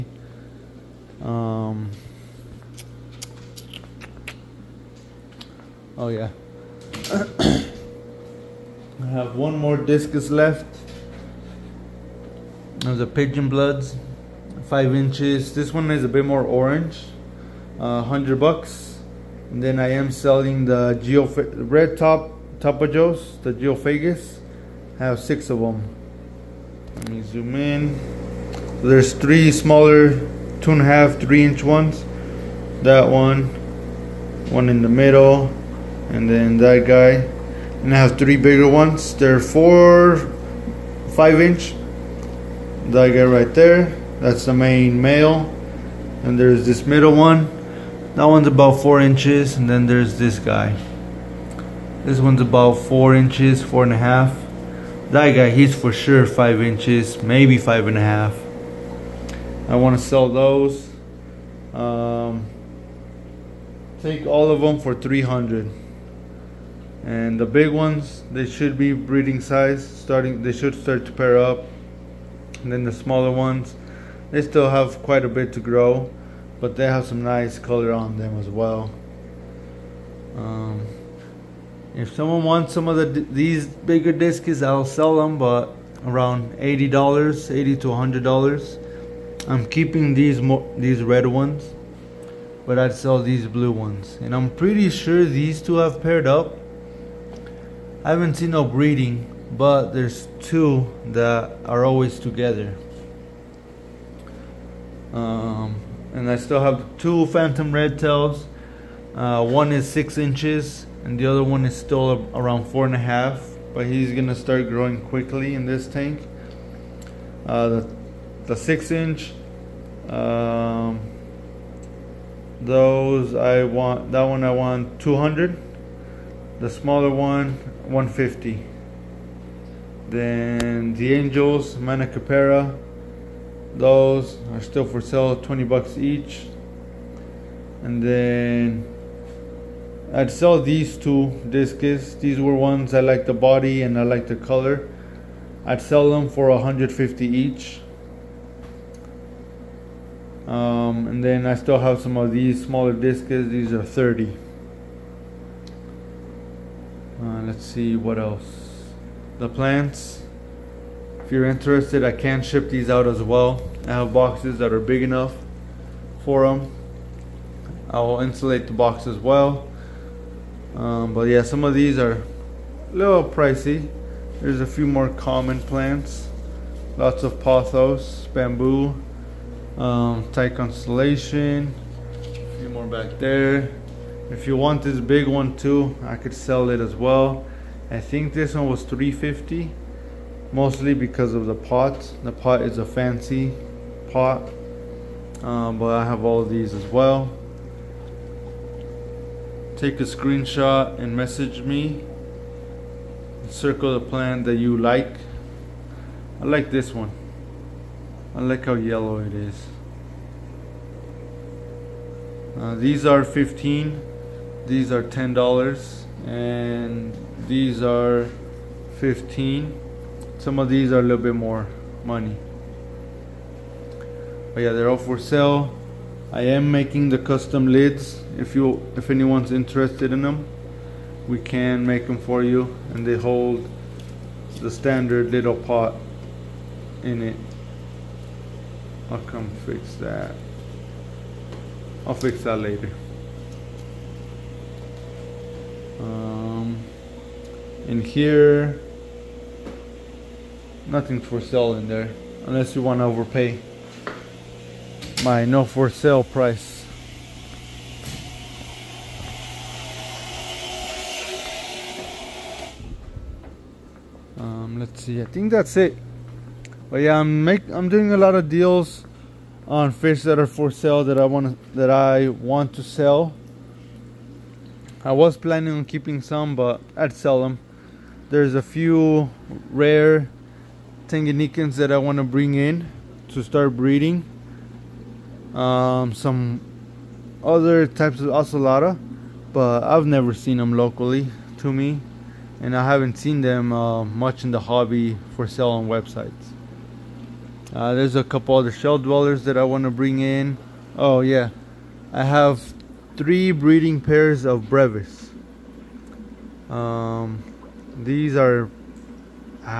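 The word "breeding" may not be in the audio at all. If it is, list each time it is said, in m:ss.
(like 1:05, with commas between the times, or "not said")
1:08, 1:38, 4:43, 5:03.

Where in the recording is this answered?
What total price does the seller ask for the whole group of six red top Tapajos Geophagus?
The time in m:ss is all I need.
1:04.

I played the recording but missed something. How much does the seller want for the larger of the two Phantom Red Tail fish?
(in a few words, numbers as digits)
$200.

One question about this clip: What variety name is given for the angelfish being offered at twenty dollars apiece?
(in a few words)
Manacapuru.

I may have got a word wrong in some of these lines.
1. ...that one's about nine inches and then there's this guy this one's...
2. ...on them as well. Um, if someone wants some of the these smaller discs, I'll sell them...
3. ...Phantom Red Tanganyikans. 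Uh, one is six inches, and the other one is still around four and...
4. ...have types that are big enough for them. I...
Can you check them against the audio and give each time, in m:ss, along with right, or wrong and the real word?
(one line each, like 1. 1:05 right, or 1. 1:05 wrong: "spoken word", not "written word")
1. 0:48 wrong: "four", not "nine"
2. 1:17 wrong: "bigger", not "smaller"
3. 1:47 wrong: "Tails", not "Tanganyikans"
4. 2:43 wrong: "boxes", not "types".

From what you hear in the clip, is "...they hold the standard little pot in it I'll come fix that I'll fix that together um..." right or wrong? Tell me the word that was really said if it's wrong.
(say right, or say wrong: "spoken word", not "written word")
wrong: "later", not "together".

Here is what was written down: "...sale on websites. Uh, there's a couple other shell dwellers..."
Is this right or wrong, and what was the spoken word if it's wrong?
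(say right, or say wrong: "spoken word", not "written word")
right.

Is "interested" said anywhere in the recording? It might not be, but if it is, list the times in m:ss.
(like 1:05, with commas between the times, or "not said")
2:41, 3:49.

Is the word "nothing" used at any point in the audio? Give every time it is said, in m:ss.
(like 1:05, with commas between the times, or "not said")
4:10.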